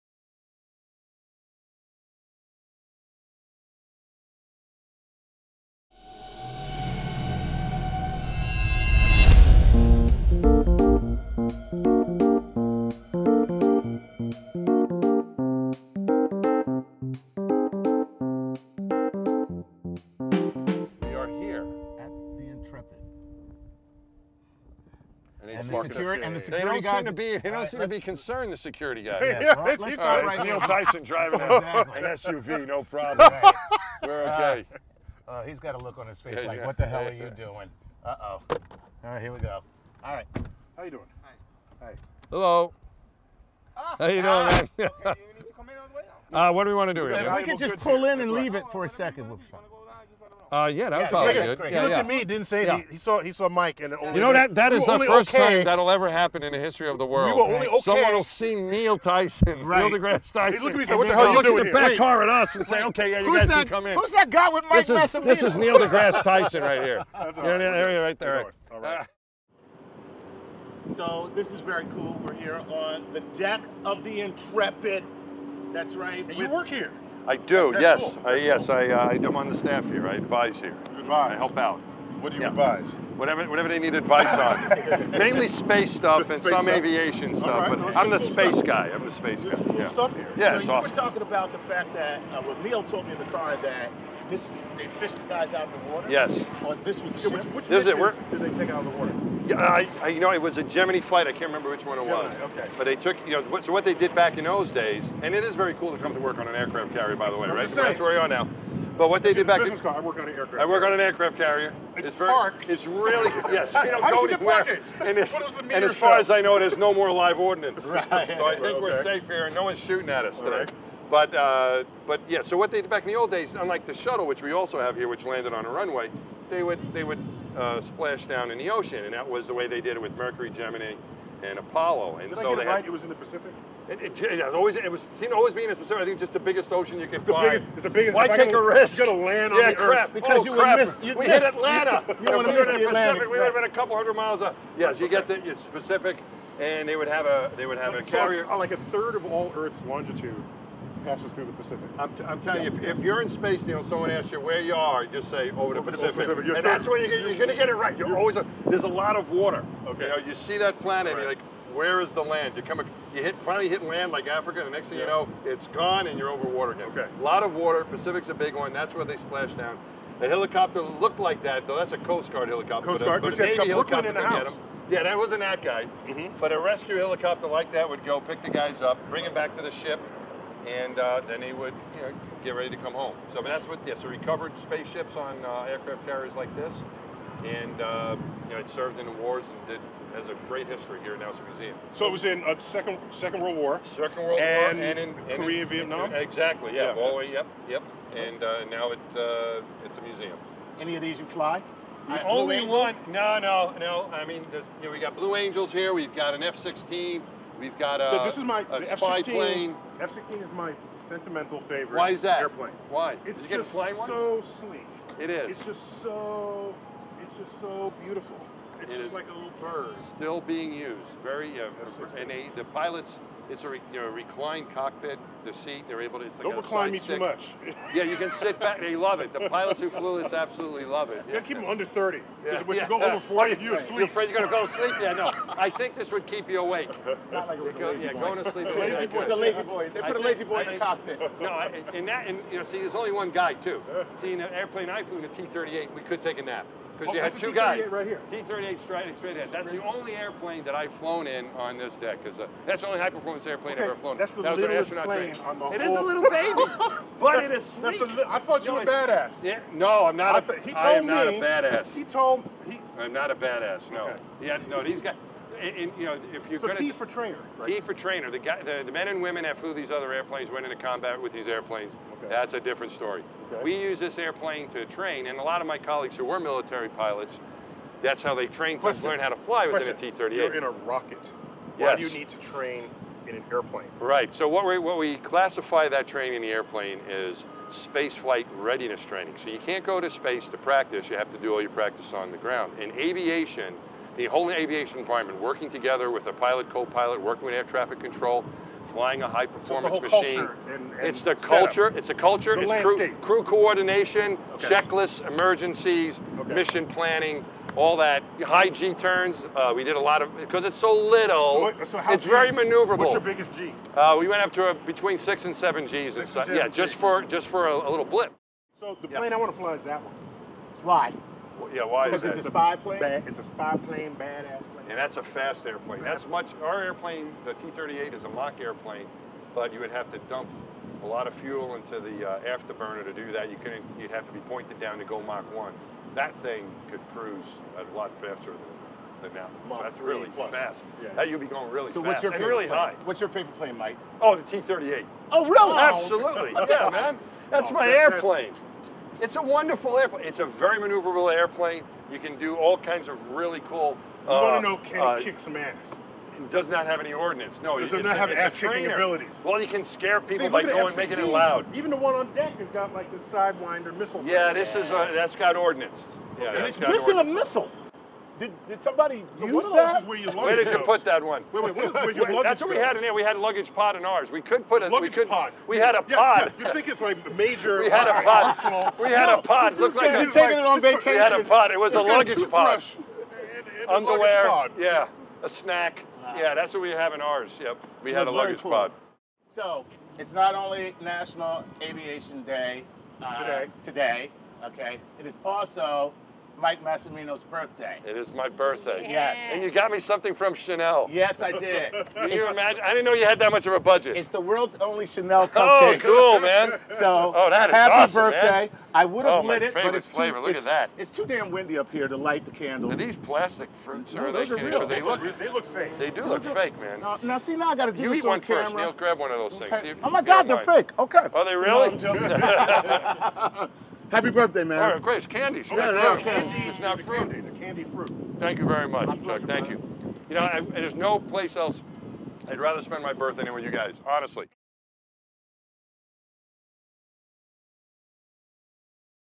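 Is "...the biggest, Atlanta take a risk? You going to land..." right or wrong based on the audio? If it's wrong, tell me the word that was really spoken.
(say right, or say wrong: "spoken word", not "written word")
wrong: "Why", not "Atlanta".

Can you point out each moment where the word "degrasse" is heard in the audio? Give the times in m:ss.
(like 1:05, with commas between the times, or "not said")
0:59, 1:05.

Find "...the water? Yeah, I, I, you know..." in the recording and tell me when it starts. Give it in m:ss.
1:38.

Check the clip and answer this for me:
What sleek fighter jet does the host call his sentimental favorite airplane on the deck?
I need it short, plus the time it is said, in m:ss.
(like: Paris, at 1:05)
F-16, at 3:29.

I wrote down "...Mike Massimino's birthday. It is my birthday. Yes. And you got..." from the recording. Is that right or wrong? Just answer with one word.
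right.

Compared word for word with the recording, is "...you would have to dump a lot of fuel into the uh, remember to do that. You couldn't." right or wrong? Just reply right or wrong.
wrong.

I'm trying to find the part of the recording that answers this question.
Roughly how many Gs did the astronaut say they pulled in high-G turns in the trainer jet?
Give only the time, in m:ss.
5:14.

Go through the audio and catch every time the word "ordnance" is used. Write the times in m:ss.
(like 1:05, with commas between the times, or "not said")
1:57, 5:57, 6:05.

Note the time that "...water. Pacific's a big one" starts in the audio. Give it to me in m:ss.
2:47.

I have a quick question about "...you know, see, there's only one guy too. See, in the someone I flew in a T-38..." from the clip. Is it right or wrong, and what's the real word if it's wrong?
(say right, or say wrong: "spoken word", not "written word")
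wrong: "airplane", not "someone".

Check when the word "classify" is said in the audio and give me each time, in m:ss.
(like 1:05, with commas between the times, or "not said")
4:45.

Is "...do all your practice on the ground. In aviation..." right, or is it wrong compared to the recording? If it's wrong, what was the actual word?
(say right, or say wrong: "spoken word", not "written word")
right.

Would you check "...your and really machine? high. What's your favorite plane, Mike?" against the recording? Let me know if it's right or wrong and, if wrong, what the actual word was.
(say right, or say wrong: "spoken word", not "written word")
wrong: "plane", not "machine".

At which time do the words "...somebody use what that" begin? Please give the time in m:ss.
6:08.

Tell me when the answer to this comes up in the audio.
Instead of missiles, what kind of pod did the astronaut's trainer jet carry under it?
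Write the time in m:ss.
6:13.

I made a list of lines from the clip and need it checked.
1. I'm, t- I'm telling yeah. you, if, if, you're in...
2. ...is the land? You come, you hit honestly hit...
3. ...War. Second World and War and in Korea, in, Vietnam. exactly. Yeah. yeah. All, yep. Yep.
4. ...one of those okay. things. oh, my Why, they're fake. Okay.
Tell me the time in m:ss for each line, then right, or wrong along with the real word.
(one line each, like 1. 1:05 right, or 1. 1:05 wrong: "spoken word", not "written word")
1. 2:31 right
2. 2:42 wrong: "finally", not "honestly"
3. 3:13 right
4. 6:59 wrong: "God", not "Why".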